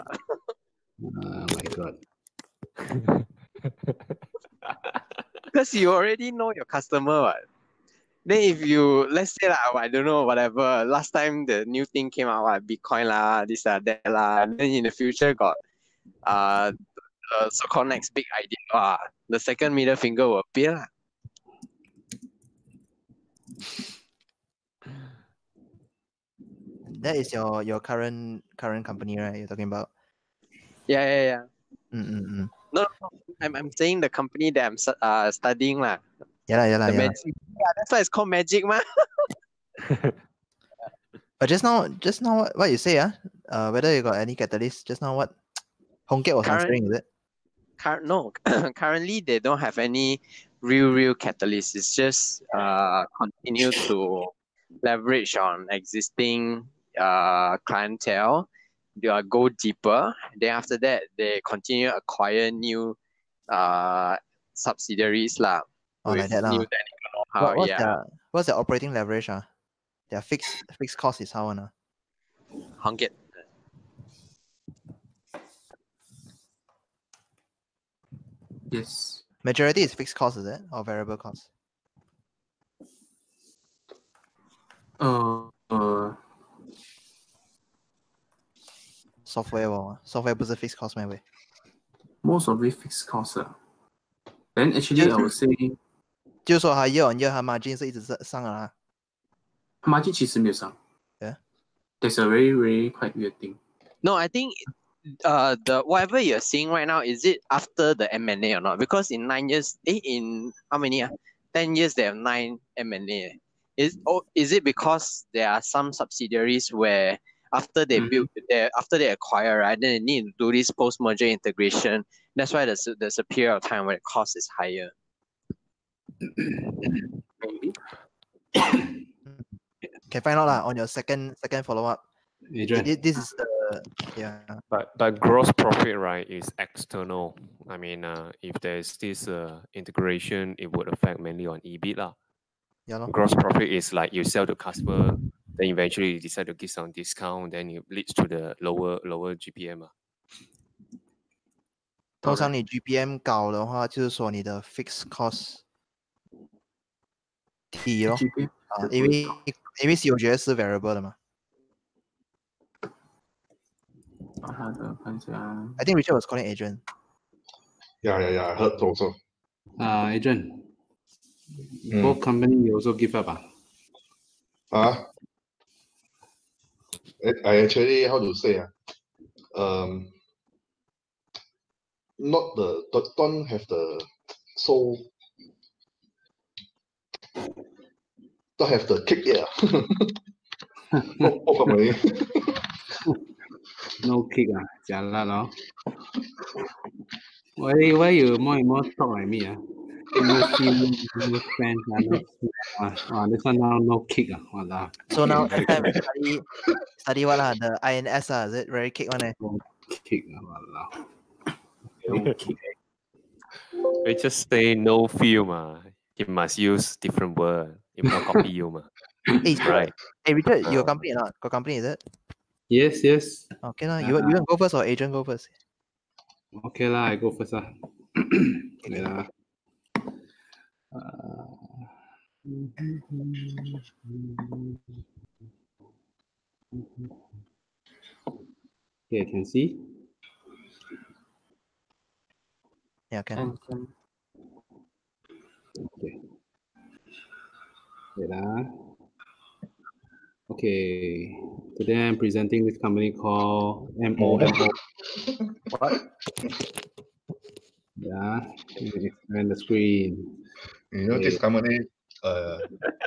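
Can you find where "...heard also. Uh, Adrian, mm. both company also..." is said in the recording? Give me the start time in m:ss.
2:48.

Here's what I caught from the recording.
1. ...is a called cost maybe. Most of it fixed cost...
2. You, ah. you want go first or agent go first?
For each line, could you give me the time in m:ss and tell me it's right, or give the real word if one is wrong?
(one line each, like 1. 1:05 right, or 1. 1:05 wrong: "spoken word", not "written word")
1. 1:30 wrong: "fixed", not "called"
2. 3:44 right.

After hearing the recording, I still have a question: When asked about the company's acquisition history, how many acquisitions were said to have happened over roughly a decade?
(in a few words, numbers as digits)
9.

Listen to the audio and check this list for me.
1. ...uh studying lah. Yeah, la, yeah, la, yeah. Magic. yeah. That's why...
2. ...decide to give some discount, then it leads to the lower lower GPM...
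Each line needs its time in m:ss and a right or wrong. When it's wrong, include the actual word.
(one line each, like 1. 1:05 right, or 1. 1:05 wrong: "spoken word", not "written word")
1. 0:35 right
2. 2:26 right.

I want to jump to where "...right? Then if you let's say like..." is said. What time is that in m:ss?
0:07.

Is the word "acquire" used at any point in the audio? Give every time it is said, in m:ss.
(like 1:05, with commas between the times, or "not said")
1:01, 1:59.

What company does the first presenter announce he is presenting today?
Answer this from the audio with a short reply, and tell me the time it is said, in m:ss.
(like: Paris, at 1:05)
MOMO, at 4:13.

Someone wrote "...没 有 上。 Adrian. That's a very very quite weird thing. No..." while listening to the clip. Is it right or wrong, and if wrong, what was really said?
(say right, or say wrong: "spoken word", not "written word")
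wrong: "Yeah", not "Adrian".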